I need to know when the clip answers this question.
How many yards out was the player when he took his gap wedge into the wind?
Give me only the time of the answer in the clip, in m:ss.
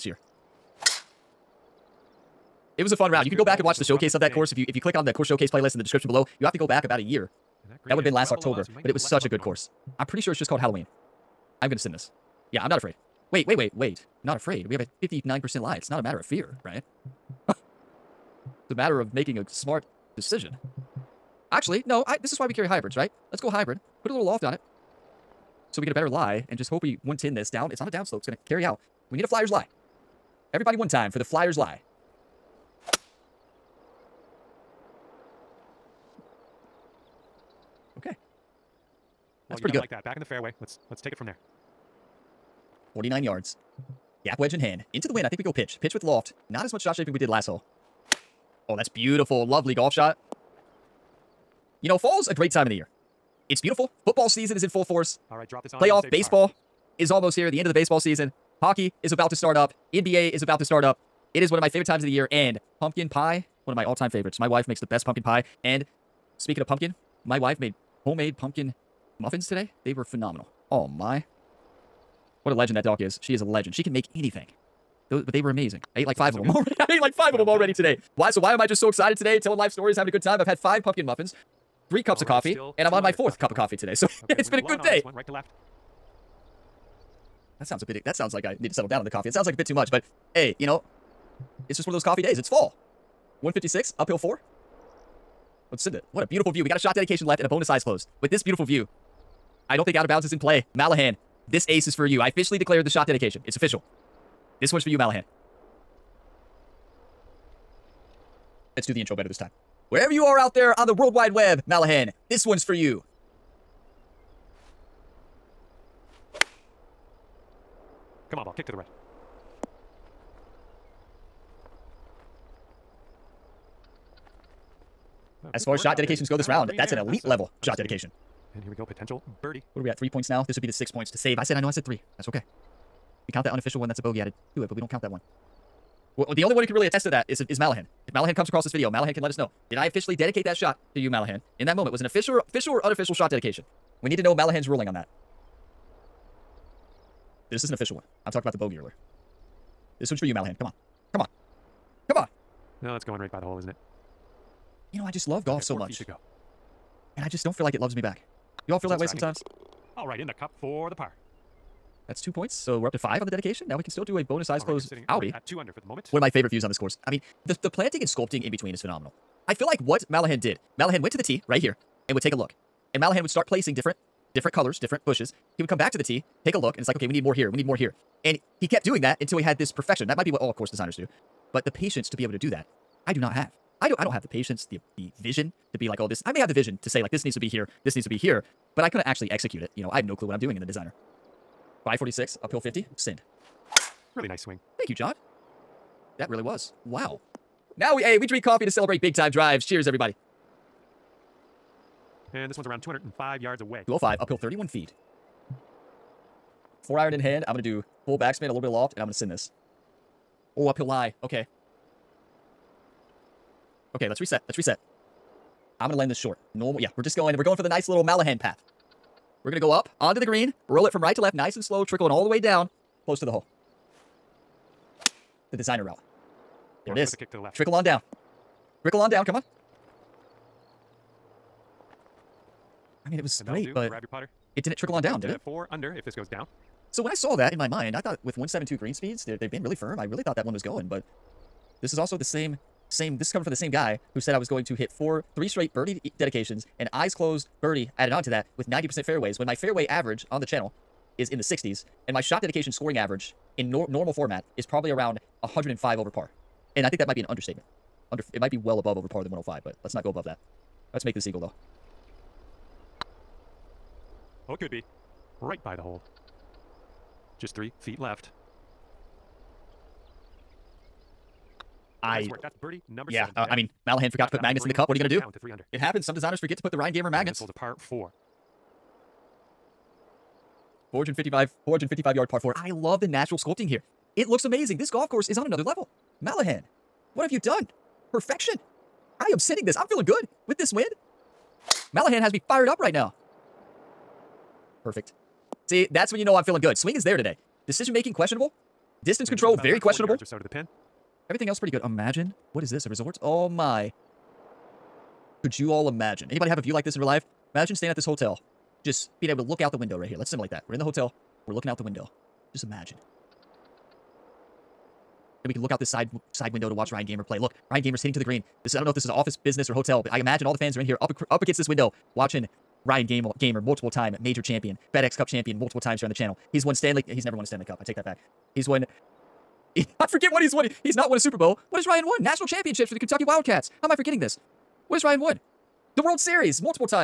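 0:42.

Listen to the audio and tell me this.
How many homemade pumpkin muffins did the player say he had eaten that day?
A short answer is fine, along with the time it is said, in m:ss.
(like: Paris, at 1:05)
5, at 1:20.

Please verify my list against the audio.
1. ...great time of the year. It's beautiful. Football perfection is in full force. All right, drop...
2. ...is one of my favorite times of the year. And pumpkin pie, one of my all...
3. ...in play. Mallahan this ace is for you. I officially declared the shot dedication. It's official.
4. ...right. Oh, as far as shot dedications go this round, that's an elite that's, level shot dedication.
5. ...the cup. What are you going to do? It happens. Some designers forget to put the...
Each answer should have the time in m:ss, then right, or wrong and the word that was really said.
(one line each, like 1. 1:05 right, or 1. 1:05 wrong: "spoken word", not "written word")
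1. 0:52 wrong: "season", not "perfection"
2. 1:01 right
3. 1:40 right
4. 1:58 right
5. 4:34 right.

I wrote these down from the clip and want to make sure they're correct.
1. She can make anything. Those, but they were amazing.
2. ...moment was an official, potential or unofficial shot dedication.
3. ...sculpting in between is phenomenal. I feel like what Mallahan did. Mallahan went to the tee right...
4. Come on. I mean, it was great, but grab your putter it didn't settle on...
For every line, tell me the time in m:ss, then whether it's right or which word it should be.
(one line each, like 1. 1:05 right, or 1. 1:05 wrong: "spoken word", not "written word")
1. 1:13 right
2. 2:21 wrong: "official", not "potential"
3. 2:48 right
4. 3:49 wrong: "trickle", not "settle".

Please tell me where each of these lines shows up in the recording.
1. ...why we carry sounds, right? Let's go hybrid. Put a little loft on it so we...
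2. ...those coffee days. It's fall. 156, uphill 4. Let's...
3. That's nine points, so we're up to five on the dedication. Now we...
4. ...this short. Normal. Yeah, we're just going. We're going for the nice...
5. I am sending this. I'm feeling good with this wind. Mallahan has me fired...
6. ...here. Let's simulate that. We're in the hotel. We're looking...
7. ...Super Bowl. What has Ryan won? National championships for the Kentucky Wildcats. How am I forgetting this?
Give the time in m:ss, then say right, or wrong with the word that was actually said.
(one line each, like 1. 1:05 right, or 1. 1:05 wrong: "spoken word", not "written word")
1. 0:22 wrong: "hybrids", not "sounds"
2. 1:31 right
3. 2:42 wrong: "two", not "nine"
4. 3:36 right
5. 4:49 right
6. 5:10 right
7. 5:31 right.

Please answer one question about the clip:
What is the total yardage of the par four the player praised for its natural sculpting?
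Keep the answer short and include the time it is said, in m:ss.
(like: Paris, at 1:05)
455, at 4:41.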